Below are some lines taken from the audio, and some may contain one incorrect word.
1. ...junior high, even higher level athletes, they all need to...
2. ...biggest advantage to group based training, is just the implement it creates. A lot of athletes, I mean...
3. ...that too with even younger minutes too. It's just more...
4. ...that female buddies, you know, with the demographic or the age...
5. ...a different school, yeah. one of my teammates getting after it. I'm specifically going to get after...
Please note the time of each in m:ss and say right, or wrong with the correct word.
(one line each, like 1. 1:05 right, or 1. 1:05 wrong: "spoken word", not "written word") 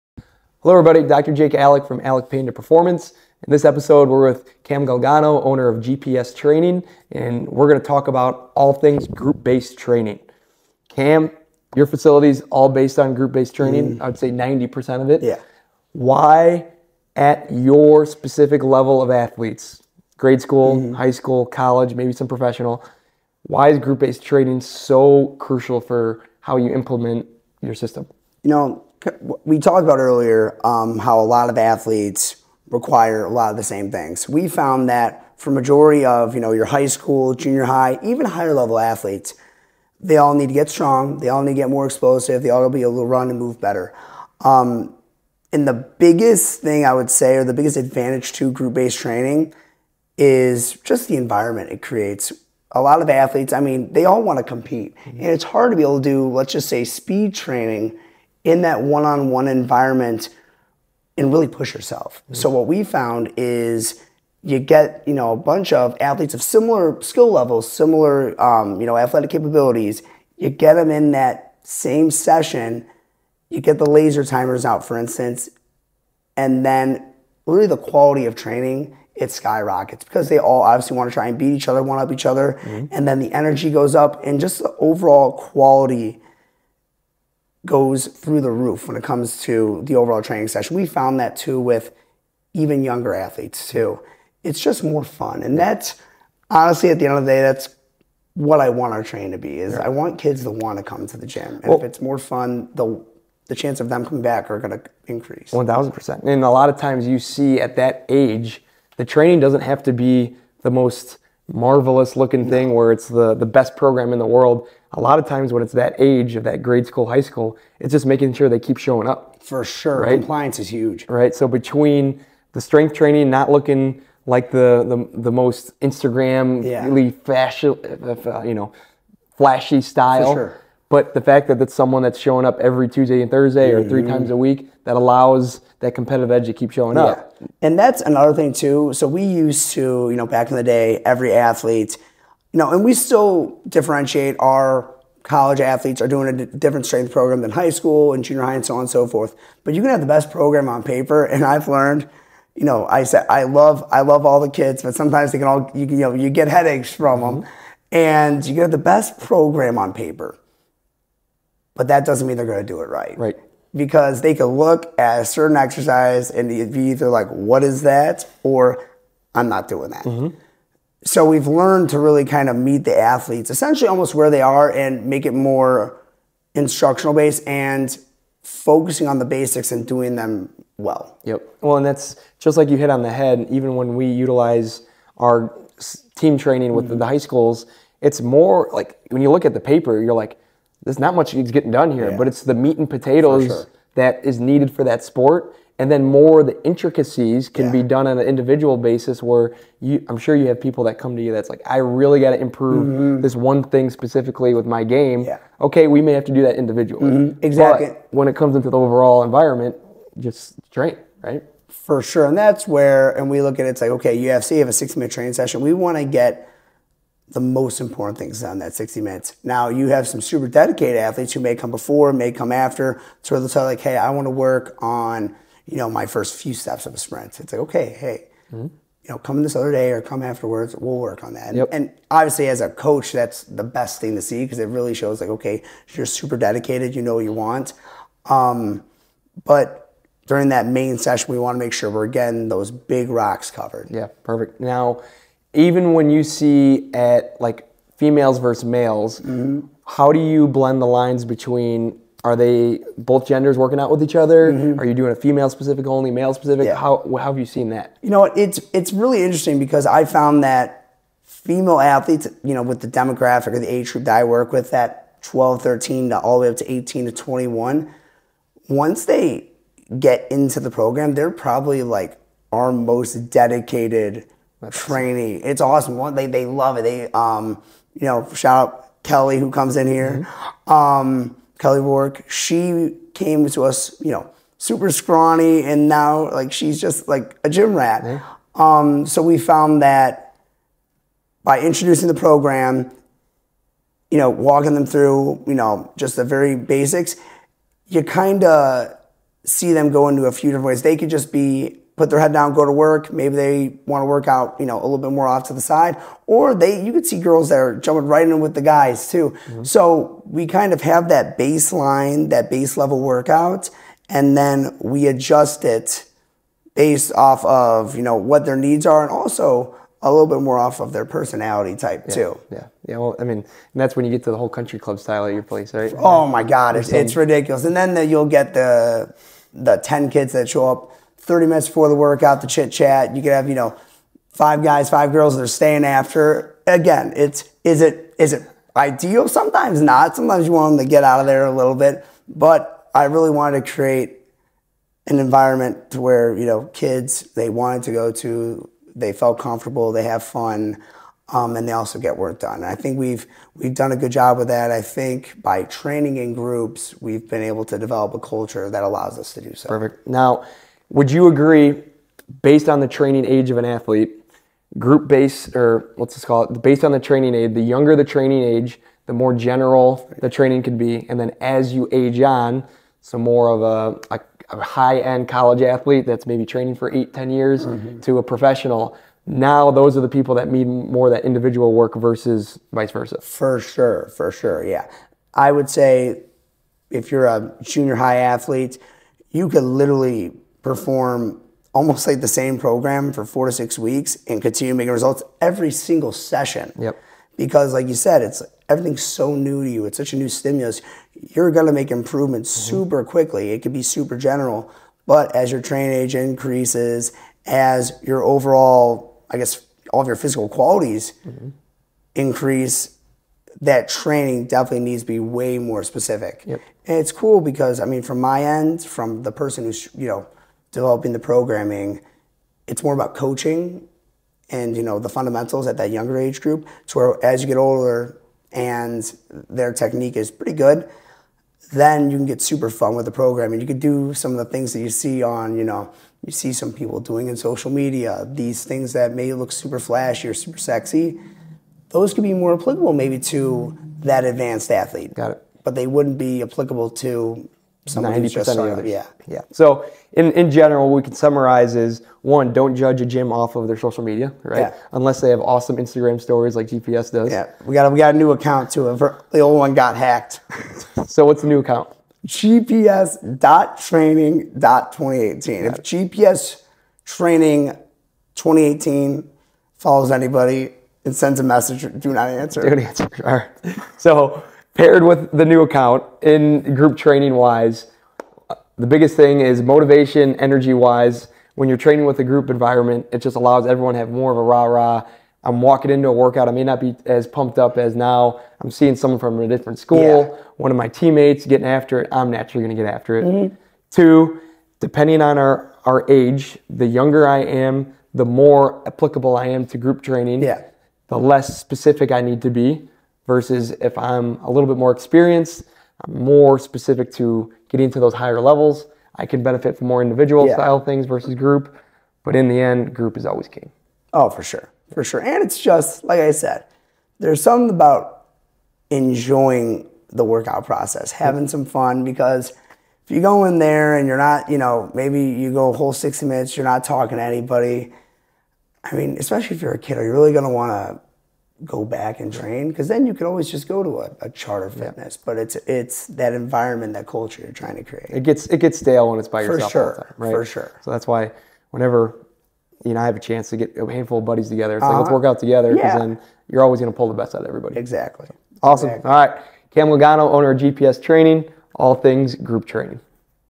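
1. 0:37 right
2. 0:47 wrong: "environment", not "implement"
3. 1:31 wrong: "athletes", not "minutes"
4. 4:20 wrong: "athletes", not "buddies"
5. 8:09 wrong: "naturally", not "specifically".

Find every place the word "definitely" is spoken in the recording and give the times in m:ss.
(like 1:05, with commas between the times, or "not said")
6:54.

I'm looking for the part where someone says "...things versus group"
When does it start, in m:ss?
8:30.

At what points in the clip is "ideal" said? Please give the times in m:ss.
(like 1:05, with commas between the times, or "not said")
5:38.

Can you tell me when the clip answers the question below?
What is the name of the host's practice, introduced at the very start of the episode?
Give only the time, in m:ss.
0:02.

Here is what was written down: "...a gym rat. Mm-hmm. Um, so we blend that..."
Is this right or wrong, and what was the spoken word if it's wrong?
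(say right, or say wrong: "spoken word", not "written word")
wrong: "found", not "blend".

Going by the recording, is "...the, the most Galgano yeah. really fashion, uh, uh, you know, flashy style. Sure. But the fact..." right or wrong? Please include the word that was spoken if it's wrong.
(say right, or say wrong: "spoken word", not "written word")
wrong: "Instagram", not "Galgano".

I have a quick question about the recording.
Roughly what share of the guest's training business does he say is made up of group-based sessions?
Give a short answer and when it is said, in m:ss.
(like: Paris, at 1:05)
90%, at 0:14.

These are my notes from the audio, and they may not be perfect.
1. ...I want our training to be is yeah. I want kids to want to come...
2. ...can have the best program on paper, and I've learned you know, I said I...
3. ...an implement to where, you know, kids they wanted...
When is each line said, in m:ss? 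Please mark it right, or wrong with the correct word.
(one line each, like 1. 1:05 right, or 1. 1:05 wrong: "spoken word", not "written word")
1. 1:38 right
2. 2:29 right
3. 5:45 wrong: "environment", not "implement".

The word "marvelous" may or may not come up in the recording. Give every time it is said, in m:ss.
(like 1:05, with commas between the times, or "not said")
1:51.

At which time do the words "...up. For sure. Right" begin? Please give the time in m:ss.
1:59.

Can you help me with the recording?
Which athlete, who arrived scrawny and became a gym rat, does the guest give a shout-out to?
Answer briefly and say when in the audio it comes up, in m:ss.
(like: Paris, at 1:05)
Kelly Wark, at 4:41.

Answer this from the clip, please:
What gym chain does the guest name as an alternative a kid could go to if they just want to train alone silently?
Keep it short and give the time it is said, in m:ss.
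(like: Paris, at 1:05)
Charter Fitness, at 8:54.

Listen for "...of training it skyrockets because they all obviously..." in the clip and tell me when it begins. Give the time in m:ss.
1:18.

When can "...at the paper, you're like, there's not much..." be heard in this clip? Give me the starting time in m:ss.
3:09.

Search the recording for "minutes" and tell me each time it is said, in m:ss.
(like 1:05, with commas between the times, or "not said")
3:34, 3:39, 5:31, 8:46.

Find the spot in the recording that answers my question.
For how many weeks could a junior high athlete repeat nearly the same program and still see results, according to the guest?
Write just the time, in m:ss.
6:33.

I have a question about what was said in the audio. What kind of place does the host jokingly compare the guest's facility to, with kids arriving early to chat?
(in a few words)
country club.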